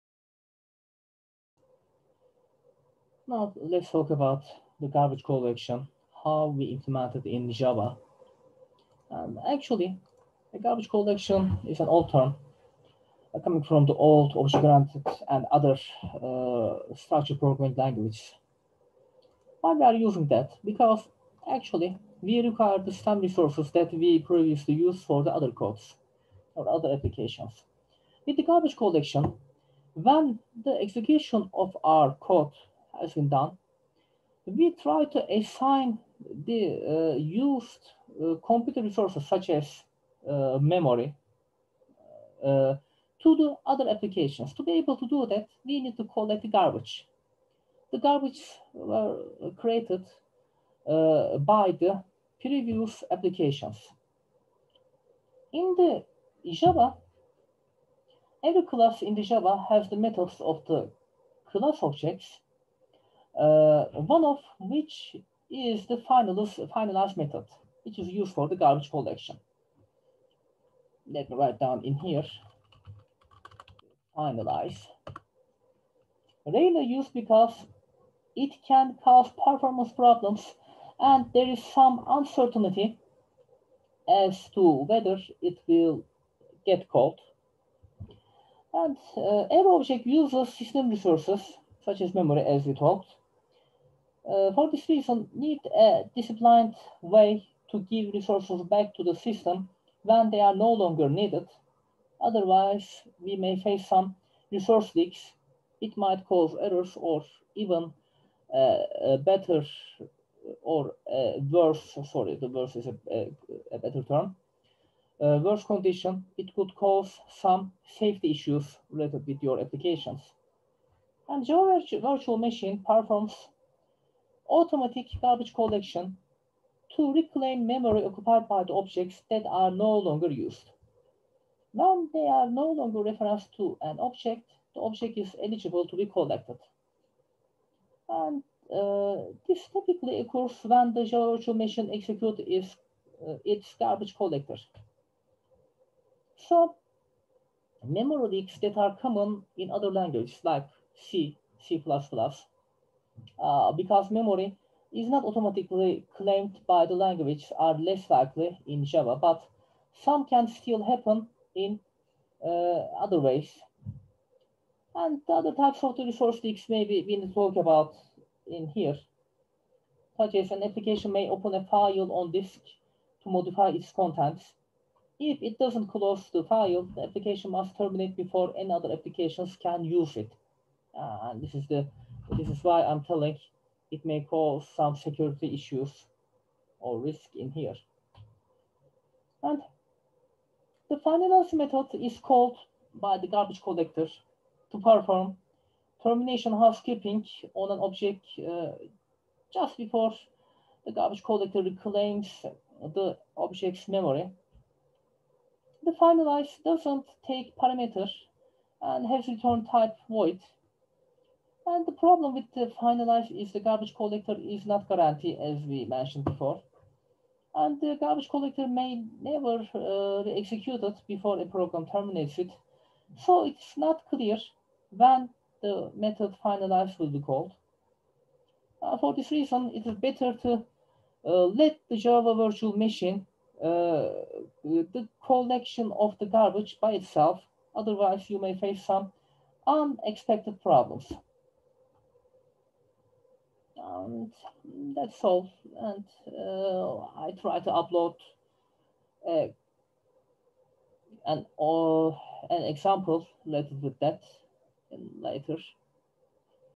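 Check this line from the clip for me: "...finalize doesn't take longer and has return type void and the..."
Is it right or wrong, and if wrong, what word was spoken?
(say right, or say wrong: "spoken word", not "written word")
wrong: "parameter", not "longer".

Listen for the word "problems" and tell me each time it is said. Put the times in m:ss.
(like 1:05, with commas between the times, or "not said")
1:19, 3:31, 4:00.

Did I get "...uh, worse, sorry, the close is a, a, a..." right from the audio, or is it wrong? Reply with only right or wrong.
wrong.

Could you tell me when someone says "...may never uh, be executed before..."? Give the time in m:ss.
3:38.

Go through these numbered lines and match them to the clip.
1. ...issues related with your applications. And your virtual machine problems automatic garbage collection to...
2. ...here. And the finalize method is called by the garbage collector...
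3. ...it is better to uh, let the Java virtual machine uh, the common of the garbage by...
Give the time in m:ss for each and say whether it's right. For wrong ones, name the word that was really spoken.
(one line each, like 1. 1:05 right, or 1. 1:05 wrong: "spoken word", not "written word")
1. 1:58 wrong: "performs", not "problems"
2. 3:07 right
3. 3:49 wrong: "collection", not "common".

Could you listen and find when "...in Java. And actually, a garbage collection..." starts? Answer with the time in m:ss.
0:07.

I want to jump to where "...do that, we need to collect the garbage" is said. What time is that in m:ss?
0:45.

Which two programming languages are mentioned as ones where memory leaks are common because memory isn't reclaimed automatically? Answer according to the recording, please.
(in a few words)
C, C++.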